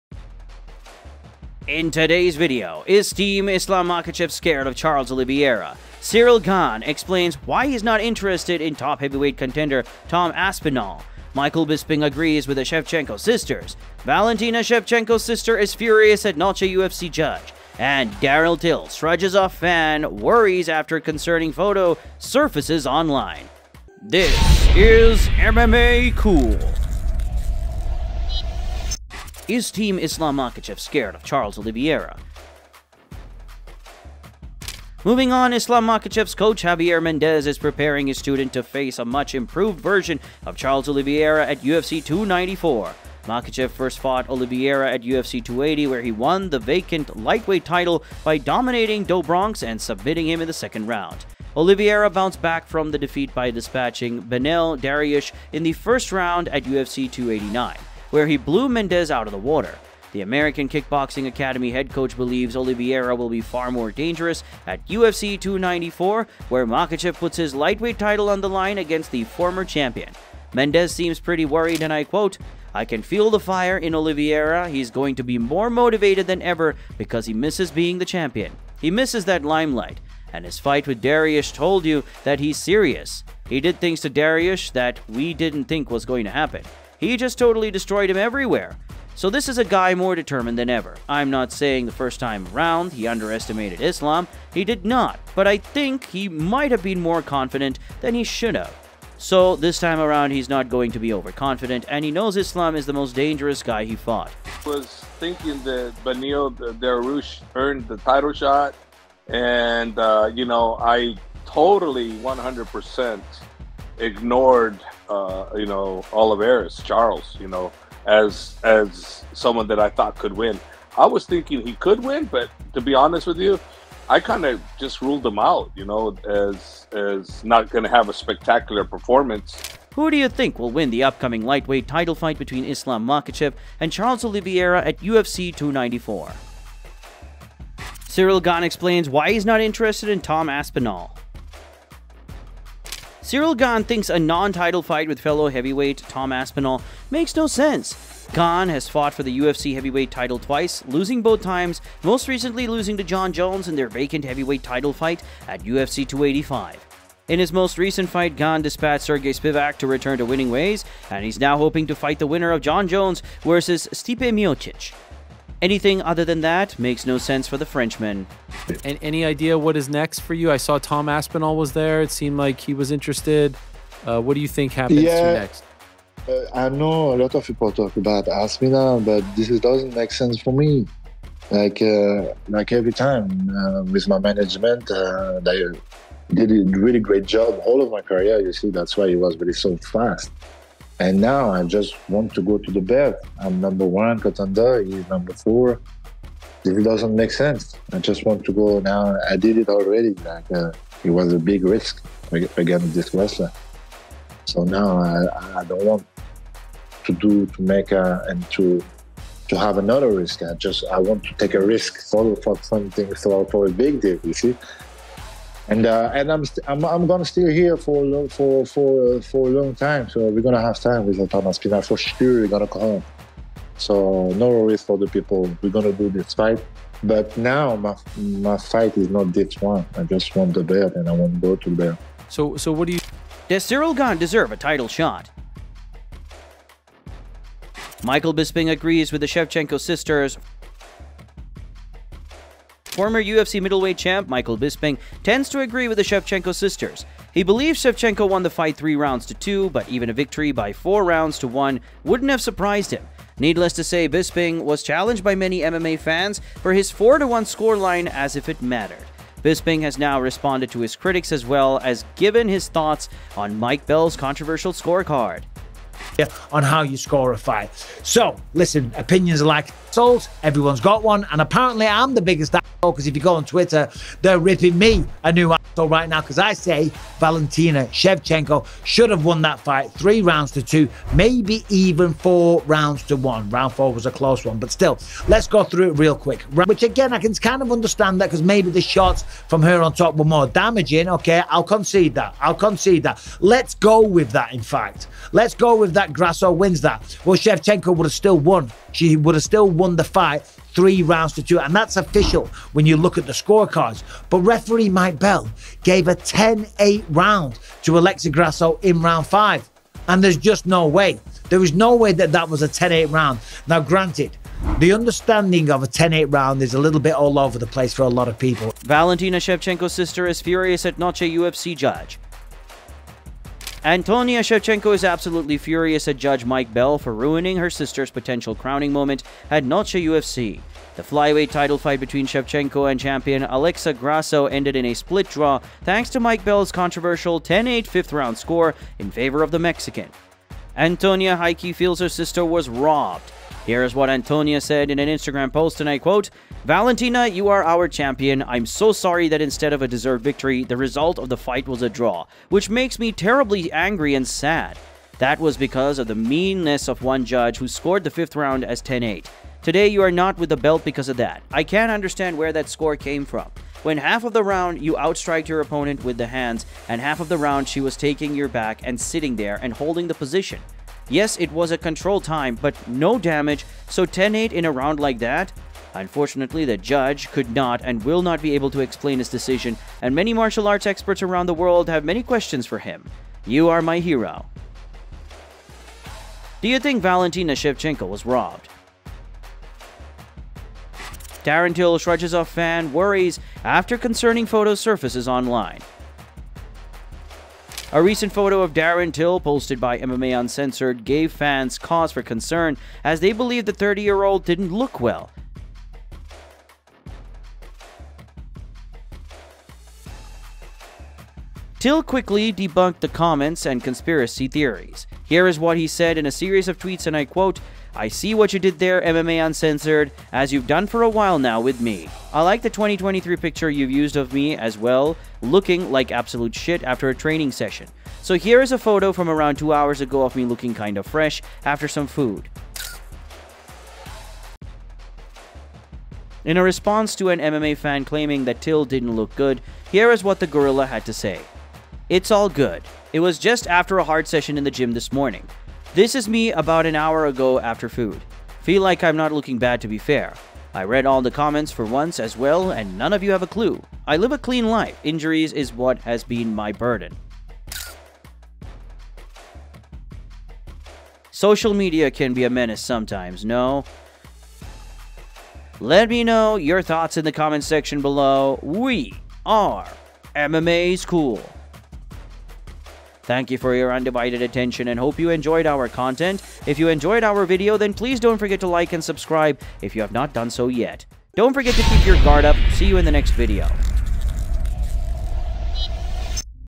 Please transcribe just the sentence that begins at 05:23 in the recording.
Antonina Shevchenko is absolutely furious at Judge Mike Bell for ruining her sister's potential crowning moment at Noche UFC.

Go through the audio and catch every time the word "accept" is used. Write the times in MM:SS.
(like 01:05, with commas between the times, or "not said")
not said.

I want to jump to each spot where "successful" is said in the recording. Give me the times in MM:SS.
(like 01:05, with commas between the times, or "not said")
not said.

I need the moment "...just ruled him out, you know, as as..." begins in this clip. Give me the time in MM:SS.
02:04.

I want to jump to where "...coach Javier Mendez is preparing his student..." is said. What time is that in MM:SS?
00:36.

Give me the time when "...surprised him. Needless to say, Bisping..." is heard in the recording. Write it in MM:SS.
04:12.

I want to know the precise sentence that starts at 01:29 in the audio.
So this is a guy more determined than ever.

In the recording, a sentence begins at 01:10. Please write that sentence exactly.
Mendez seems pretty worried, and I quote, I can feel the fire in Oliveira.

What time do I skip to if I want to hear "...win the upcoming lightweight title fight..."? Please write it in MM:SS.
02:10.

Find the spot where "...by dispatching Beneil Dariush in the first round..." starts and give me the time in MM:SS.
00:53.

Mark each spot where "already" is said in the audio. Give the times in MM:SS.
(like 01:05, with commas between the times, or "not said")
03:19.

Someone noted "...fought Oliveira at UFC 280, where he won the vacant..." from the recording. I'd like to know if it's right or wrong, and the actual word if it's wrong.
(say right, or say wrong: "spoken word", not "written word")
right.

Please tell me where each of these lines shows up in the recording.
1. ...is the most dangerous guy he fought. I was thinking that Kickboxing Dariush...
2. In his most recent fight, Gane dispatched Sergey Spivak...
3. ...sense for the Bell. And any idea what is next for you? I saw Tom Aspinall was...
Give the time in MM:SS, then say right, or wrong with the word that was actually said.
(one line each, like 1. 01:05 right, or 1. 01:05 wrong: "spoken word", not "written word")
1. 01:42 wrong: "Beneil", not "Kickboxing"
2. 02:37 right
3. 02:47 wrong: "Frenchman", not "Bell".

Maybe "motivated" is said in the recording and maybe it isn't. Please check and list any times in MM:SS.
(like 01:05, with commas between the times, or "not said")
01:15.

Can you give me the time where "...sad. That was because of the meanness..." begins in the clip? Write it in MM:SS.
05:54.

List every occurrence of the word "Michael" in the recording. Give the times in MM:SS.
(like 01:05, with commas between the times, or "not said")
00:11, 03:58, 04:04.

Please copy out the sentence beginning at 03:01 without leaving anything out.
Like uh, like every time uh, with my management, uh, they did a really great job all of my career.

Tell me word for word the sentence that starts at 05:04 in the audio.
But referee Mike Bell gave a 10 8 round to Alexa Grasso in round five.